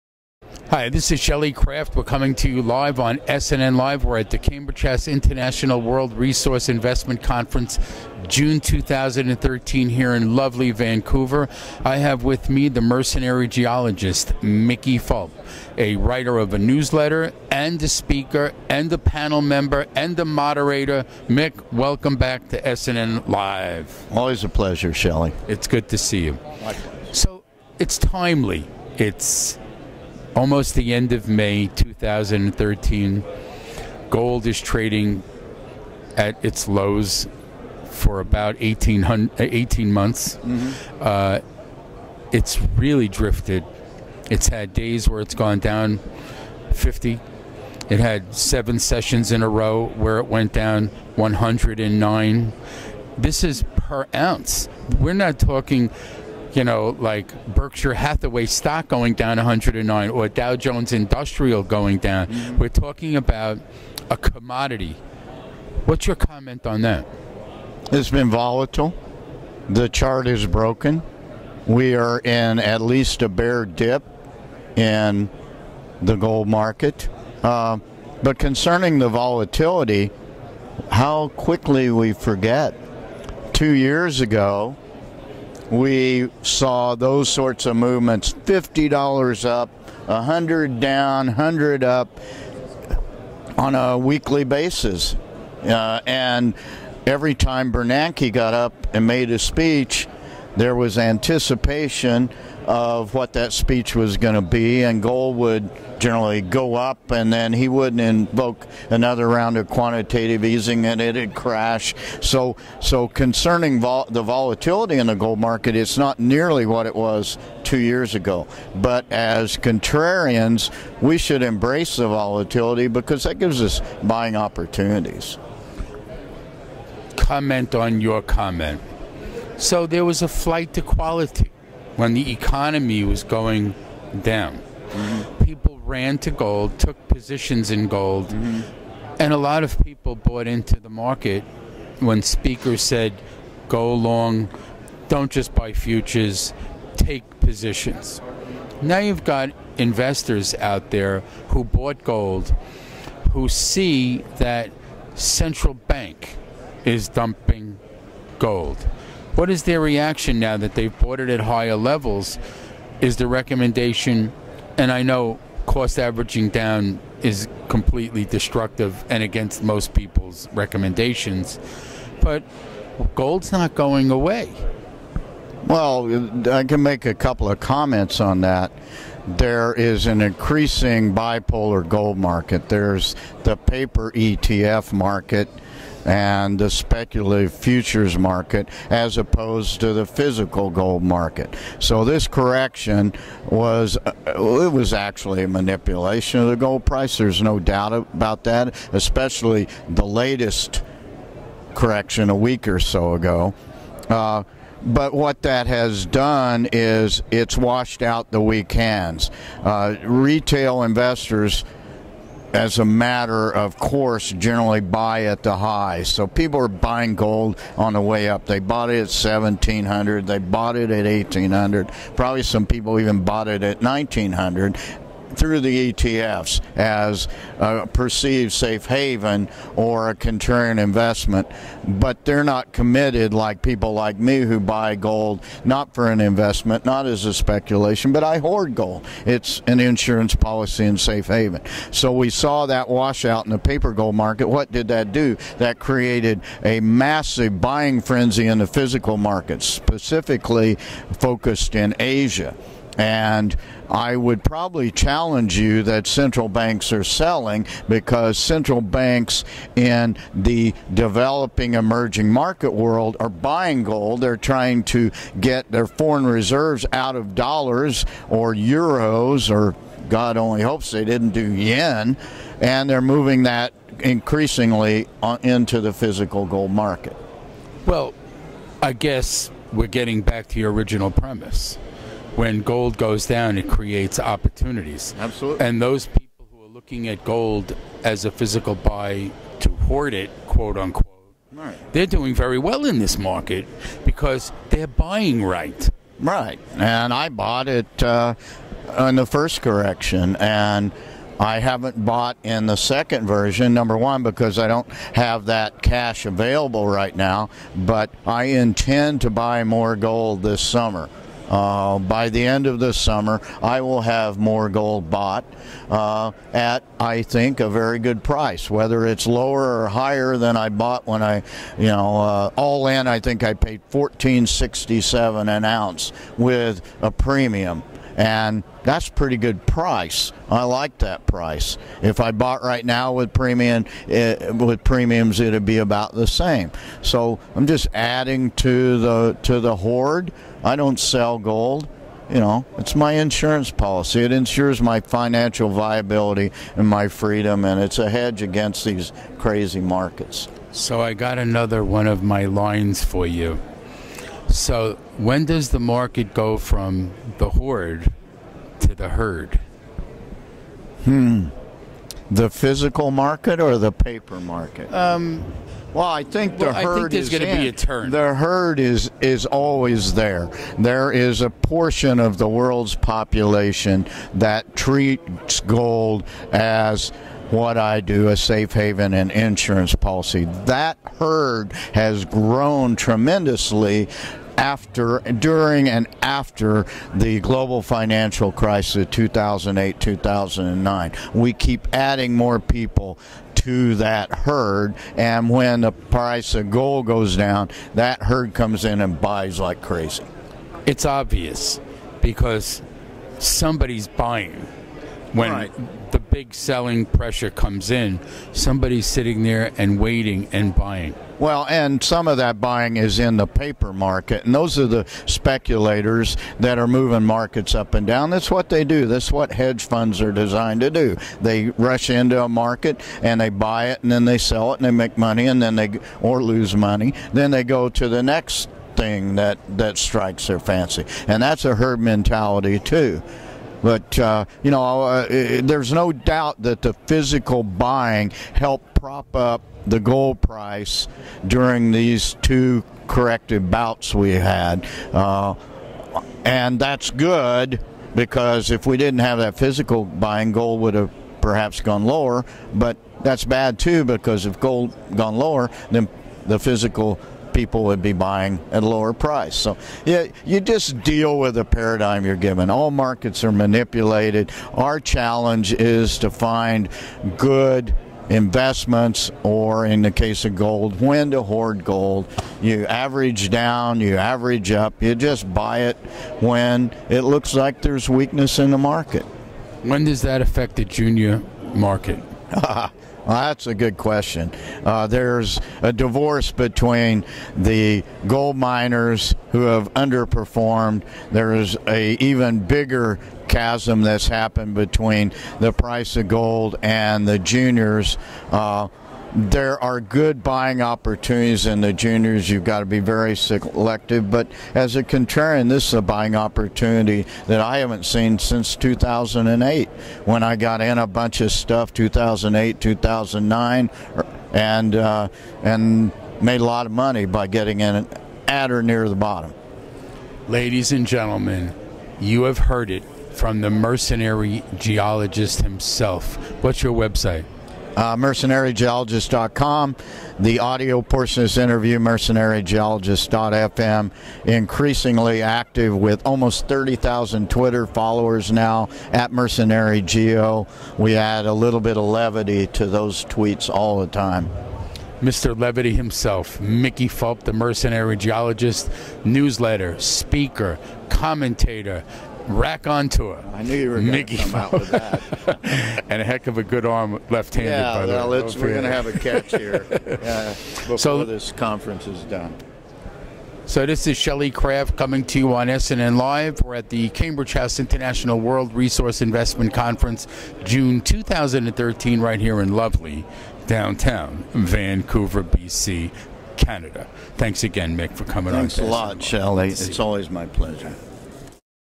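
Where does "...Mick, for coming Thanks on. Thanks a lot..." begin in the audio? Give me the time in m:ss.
9:37.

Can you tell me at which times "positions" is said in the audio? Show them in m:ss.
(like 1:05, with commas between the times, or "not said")
2:17, 2:27.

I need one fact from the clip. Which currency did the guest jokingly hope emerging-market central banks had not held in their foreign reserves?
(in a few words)
yen.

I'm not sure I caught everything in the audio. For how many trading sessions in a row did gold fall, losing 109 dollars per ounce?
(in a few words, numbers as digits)
7.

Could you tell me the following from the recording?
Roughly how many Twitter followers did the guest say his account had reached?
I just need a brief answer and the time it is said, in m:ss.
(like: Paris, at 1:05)
30,000, at 8:56.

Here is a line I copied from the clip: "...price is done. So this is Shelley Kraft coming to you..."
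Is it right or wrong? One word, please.
wrong.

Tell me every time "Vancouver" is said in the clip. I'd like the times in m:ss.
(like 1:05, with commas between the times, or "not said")
0:10, 9:34.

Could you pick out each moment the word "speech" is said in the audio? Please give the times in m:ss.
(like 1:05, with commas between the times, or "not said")
1:39, 1:43.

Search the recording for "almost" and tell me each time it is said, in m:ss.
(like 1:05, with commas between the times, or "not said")
0:30, 8:56.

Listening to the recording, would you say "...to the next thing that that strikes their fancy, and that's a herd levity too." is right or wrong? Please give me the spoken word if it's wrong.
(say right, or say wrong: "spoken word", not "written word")
wrong: "mentality", not "levity".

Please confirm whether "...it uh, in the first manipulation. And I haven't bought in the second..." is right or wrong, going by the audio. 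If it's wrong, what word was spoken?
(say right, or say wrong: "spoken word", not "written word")
wrong: "correction", not "manipulation".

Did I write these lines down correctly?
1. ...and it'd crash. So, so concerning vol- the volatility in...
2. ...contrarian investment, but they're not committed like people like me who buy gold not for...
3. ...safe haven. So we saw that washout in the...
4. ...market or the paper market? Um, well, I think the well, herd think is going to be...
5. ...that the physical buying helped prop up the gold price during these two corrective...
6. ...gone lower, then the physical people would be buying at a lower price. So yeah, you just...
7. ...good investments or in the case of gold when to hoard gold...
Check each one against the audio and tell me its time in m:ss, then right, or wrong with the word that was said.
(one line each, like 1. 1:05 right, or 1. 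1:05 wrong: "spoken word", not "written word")
1. 1:50 right
2. 3:50 right
3. 4:00 right
4. 6:03 right
5. 7:16 right
6. 7:35 right
7. 7:47 right.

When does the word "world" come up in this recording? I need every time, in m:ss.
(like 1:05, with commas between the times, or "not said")
0:05, 4:22, 6:12, 9:28.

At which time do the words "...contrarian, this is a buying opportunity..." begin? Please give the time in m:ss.
8:25.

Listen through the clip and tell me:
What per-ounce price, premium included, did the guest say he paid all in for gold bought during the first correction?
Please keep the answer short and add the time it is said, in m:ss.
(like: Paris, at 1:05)
$1,467, at 5:23.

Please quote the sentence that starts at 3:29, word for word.
Uh, retail investors as a matter of course generally buy at the high.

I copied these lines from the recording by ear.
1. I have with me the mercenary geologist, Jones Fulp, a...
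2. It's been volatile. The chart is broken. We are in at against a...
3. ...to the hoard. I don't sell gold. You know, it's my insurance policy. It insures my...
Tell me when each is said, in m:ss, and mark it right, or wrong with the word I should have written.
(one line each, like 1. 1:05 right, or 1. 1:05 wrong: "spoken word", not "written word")
1. 0:11 wrong: "Mickey", not "Jones"
2. 1:07 wrong: "least", not "against"
3. 5:39 right.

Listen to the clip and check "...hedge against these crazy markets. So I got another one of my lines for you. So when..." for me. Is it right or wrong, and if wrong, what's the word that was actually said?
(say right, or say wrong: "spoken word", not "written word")
right.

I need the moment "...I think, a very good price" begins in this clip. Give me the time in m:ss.
5:16.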